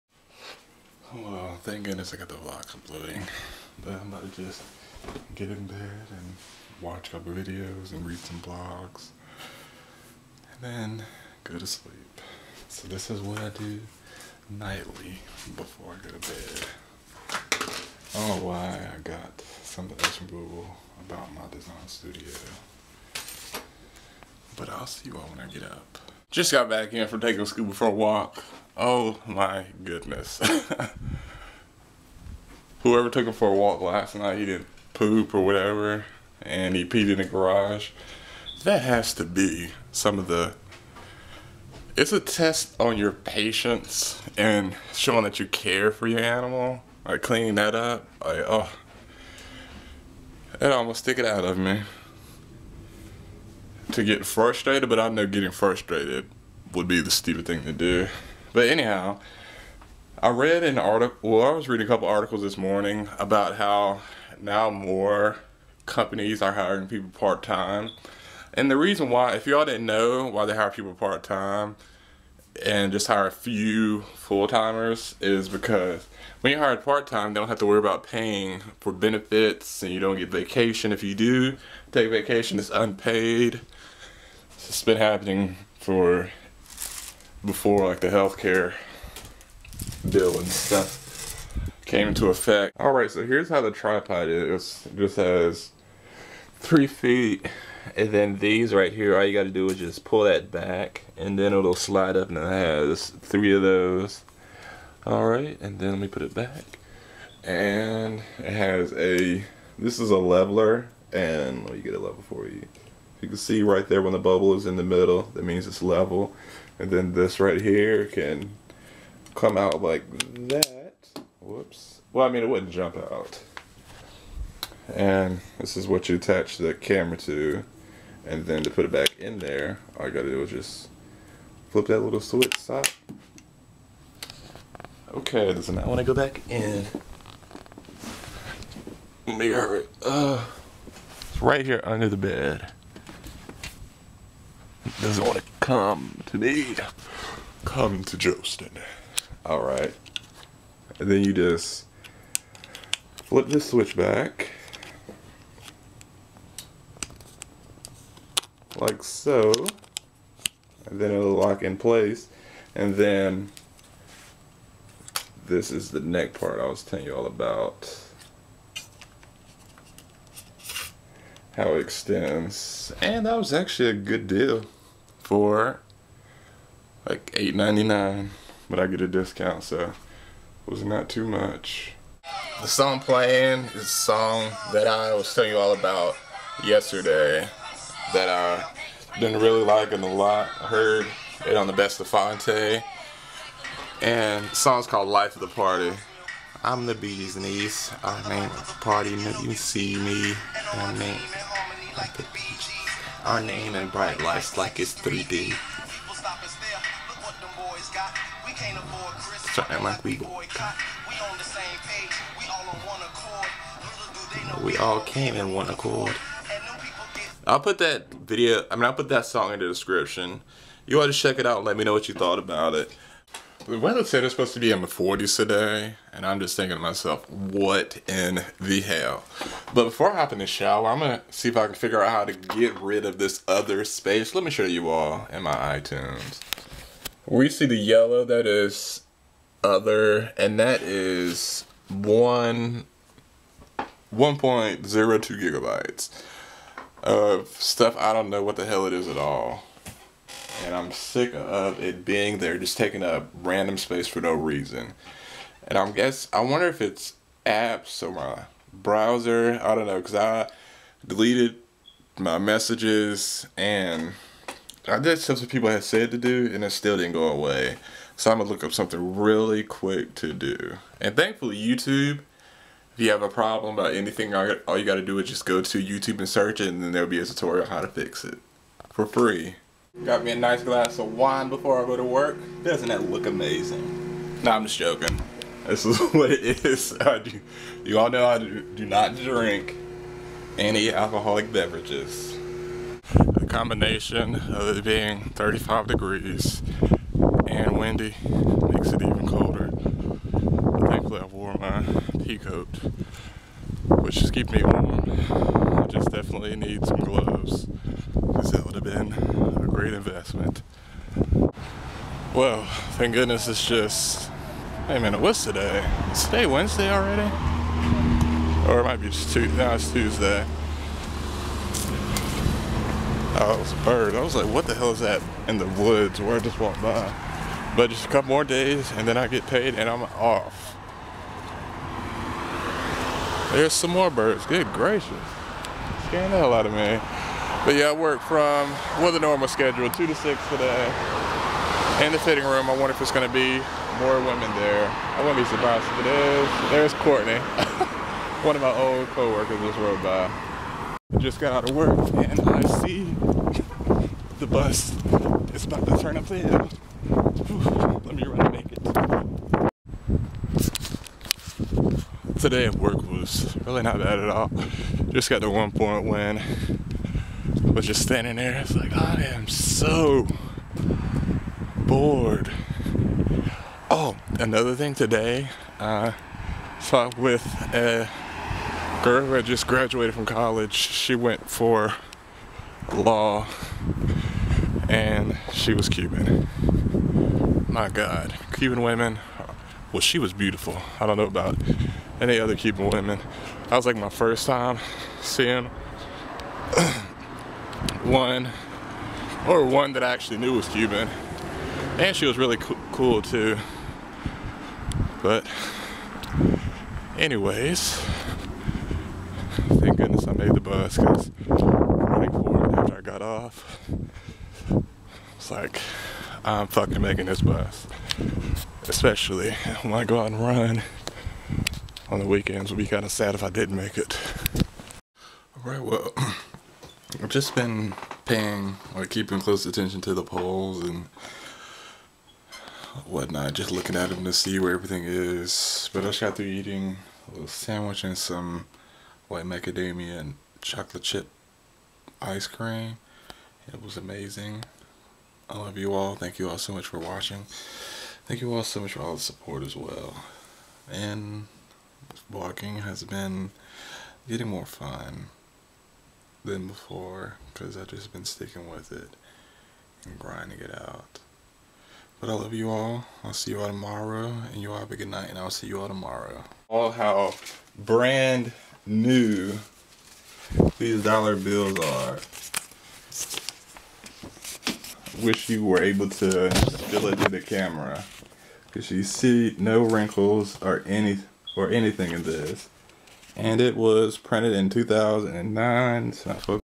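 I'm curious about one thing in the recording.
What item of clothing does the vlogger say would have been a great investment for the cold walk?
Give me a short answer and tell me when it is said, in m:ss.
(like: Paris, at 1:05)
gloves, at 5:07.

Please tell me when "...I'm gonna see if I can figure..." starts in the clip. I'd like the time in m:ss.
3:50.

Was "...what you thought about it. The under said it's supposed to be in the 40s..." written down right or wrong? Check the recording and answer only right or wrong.
wrong.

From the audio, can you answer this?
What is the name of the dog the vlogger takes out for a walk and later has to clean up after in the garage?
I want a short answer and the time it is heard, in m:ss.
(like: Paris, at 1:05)
Scooby, at 0:27.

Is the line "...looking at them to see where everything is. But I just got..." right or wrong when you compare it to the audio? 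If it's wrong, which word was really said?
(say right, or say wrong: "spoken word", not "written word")
right.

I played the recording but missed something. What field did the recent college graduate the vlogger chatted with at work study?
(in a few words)
law.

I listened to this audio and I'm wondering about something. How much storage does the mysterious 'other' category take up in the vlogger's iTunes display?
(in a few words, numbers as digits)
1.02 gigabytes.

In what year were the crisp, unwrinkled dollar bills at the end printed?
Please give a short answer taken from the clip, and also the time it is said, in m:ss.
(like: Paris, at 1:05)
2009, at 8:04.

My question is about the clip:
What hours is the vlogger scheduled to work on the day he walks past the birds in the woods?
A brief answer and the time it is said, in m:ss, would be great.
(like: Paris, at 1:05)
2 to 6, at 5:39.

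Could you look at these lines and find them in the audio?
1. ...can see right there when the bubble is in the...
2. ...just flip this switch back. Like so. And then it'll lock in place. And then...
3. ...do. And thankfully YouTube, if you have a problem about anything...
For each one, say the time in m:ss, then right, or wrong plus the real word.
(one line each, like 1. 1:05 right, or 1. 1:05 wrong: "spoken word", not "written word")
1. 1:53 right
2. 2:31 right
3. 4:30 right.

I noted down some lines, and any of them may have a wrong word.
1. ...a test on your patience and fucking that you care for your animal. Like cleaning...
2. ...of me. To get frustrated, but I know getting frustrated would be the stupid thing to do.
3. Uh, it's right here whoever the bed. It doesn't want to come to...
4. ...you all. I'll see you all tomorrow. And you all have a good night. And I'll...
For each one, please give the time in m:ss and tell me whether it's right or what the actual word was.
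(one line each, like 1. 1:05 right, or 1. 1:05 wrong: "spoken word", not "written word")
1. 0:42 wrong: "showing", not "fucking"
2. 0:51 right
3. 2:20 wrong: "under", not "whoever"
4. 7:42 right.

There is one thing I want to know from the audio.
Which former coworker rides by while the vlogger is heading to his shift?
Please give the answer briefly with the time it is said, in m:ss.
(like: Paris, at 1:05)
Courtney, at 5:46.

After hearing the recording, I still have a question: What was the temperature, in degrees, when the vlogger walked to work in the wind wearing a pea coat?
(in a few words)
35.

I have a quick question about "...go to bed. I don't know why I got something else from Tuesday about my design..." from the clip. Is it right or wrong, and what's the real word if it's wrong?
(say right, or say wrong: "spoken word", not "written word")
wrong: "Google", not "Tuesday".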